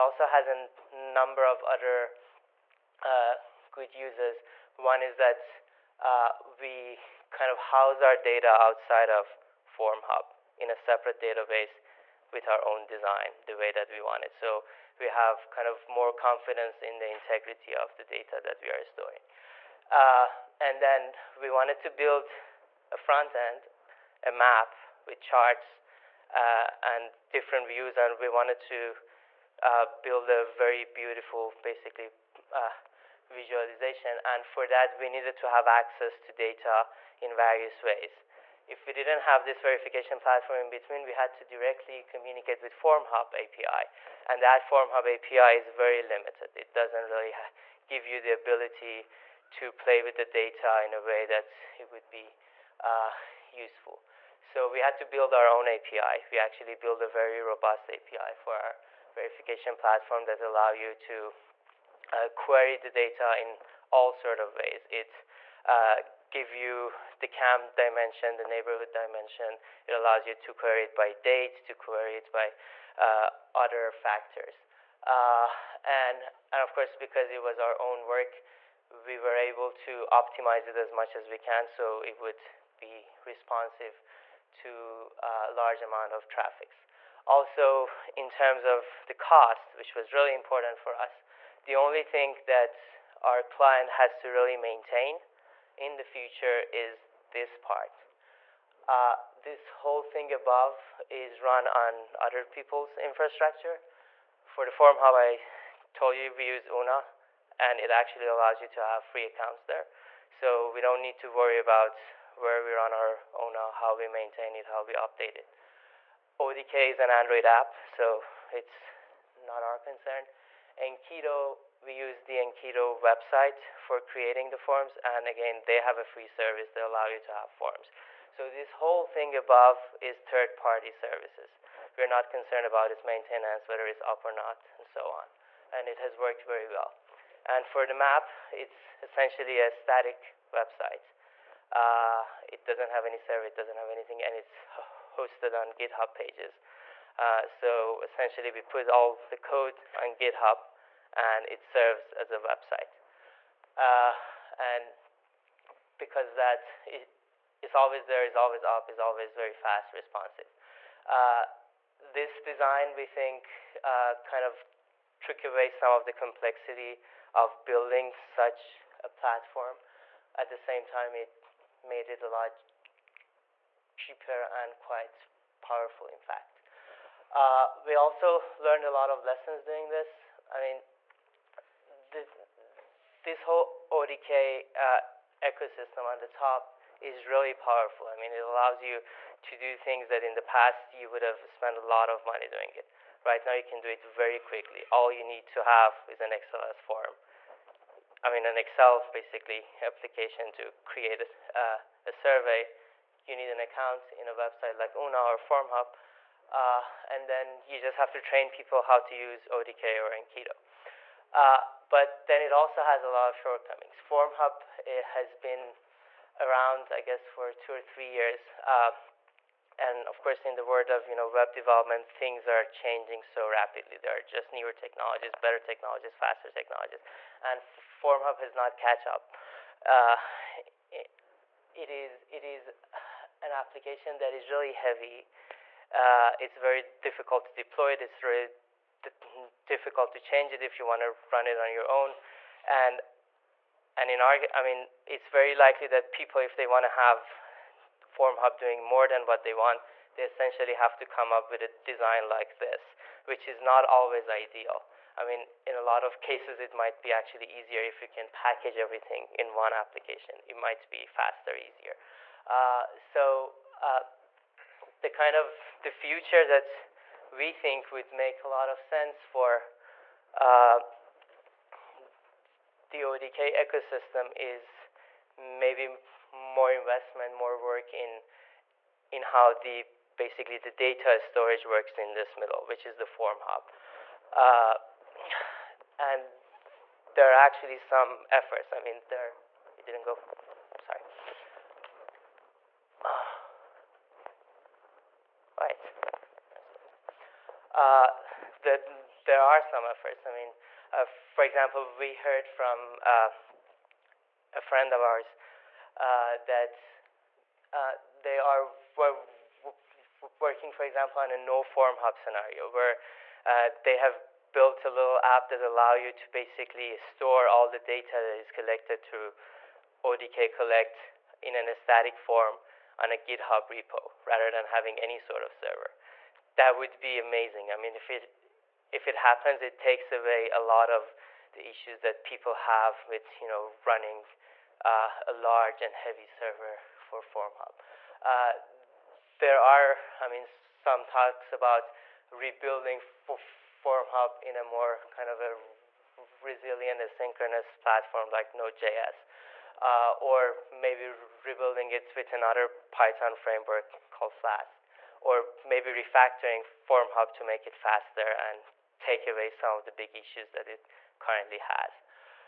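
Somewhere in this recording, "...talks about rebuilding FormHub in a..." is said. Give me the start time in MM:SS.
05:41.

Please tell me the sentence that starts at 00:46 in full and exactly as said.
It doesn't really give you the ability to play with the data in a way that it would be uh, useful.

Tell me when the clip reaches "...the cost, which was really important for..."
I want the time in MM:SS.
01:29.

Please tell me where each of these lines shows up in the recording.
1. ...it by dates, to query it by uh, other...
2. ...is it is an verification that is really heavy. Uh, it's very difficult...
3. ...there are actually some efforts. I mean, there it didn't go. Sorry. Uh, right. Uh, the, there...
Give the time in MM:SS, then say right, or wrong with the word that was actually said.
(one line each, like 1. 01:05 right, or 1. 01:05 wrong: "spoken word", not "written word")
1. 01:10 right
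2. 03:51 wrong: "application", not "verification"
3. 04:47 right.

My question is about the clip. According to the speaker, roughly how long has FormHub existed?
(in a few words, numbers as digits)
two or three years.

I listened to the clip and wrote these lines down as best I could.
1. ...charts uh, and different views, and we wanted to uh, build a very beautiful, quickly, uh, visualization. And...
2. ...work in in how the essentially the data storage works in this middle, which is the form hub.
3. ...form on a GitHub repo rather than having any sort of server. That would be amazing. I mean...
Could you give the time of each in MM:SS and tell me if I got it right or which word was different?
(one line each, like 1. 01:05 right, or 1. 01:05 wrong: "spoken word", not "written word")
1. 00:25 wrong: "basically", not "quickly"
2. 04:37 wrong: "basically", not "essentially"
3. 05:22 right.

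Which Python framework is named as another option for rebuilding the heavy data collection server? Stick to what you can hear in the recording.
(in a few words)
Flask.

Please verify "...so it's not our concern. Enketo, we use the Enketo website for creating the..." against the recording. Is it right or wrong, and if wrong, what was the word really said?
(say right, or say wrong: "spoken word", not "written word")
right.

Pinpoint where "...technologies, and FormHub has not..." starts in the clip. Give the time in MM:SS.
03:46.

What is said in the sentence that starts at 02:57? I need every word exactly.
Uh, we also learned a lot of lessons doing this.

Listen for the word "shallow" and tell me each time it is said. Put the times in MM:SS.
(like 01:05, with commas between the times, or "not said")
not said.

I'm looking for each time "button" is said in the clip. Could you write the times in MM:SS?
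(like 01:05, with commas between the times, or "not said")
not said.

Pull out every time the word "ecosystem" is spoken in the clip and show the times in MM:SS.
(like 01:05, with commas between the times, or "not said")
03:05, 04:33.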